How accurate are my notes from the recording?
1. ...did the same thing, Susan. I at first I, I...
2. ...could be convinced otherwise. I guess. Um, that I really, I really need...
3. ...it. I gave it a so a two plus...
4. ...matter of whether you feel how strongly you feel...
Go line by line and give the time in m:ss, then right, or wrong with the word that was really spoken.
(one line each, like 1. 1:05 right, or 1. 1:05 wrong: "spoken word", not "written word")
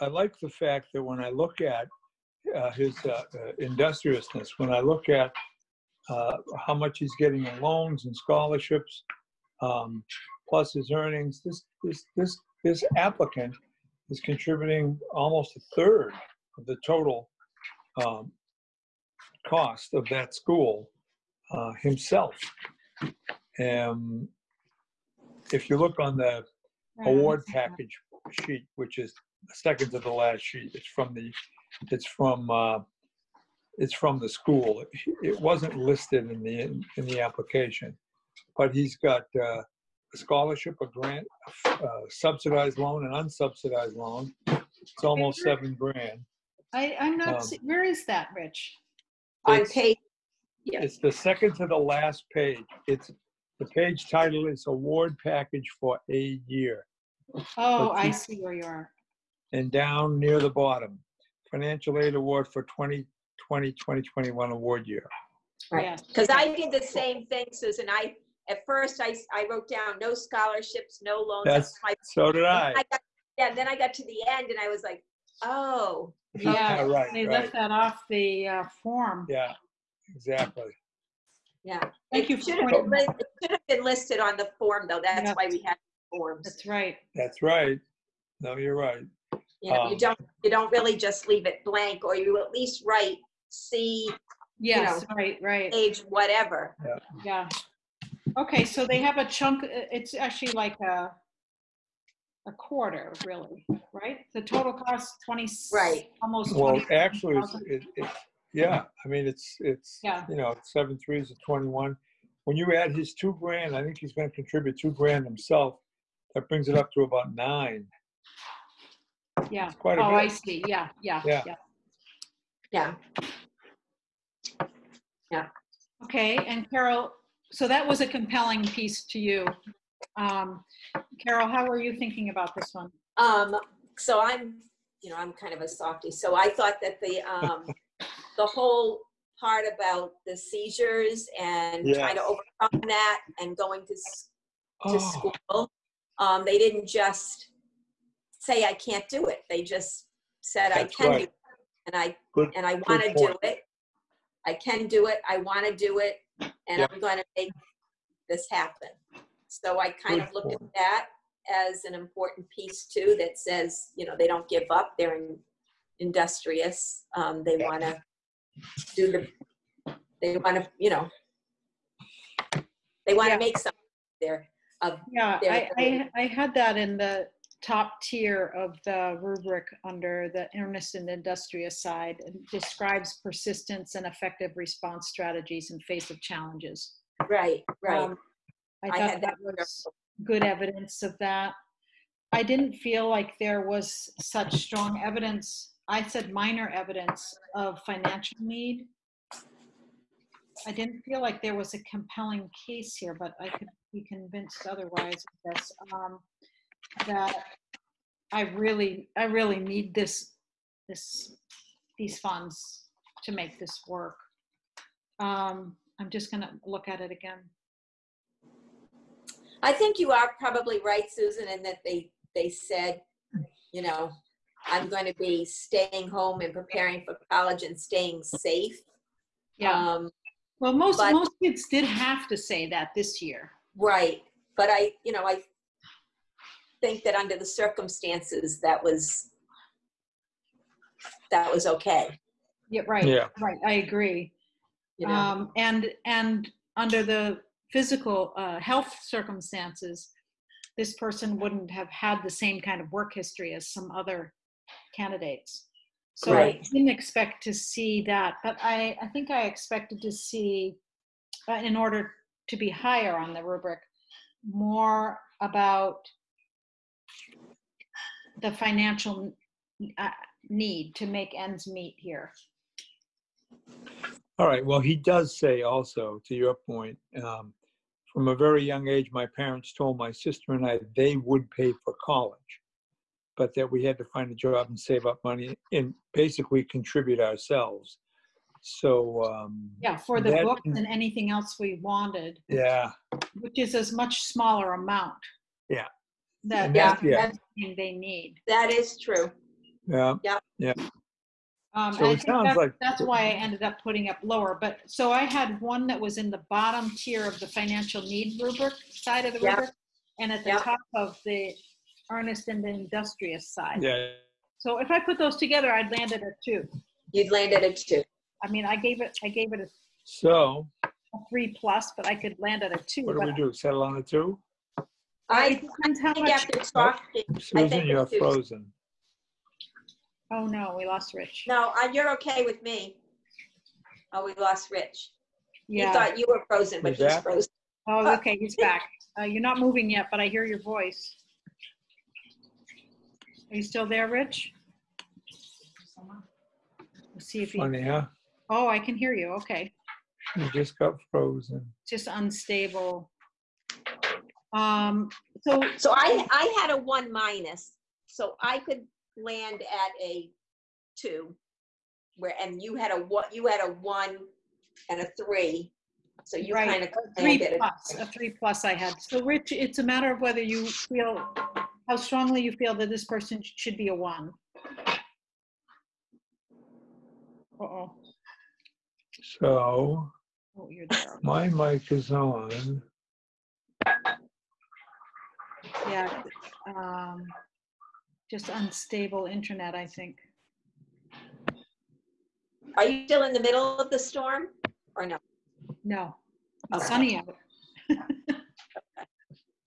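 1. 1:06 right
2. 3:23 right
3. 5:19 wrong: "three", not "two"
4. 6:09 right.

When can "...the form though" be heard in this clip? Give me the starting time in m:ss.
1:24.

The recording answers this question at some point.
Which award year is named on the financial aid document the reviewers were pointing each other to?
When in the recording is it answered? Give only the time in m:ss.
1:02.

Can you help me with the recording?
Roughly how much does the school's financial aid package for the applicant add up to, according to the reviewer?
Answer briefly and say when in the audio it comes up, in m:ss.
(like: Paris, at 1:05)
almost seven grand, at 0:45.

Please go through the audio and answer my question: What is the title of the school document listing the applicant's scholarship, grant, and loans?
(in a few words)
Award Package for a Year.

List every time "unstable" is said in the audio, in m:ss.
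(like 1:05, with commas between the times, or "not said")
5:52, 6:28.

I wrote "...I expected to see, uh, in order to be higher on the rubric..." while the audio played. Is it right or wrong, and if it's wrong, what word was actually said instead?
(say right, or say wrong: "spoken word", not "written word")
right.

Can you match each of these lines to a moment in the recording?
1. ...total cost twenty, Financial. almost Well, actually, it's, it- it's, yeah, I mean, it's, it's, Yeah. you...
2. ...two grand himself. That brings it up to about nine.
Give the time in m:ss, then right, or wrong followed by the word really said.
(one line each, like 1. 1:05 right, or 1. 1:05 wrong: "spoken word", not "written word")
1. 1:44 wrong: "Right", not "Financial"
2. 1:54 right.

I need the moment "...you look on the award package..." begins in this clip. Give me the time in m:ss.
0:25.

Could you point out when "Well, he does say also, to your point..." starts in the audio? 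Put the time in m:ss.
4:34.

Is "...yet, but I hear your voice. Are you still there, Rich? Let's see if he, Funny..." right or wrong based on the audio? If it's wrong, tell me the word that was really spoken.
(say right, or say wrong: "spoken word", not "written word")
right.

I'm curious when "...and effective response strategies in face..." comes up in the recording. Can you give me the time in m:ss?
3:03.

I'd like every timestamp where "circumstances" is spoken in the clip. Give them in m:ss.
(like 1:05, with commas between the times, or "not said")
3:57, 4:09.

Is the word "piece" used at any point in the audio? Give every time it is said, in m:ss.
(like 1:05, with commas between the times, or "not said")
2:08, 2:42.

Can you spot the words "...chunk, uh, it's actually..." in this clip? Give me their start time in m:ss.
1:39.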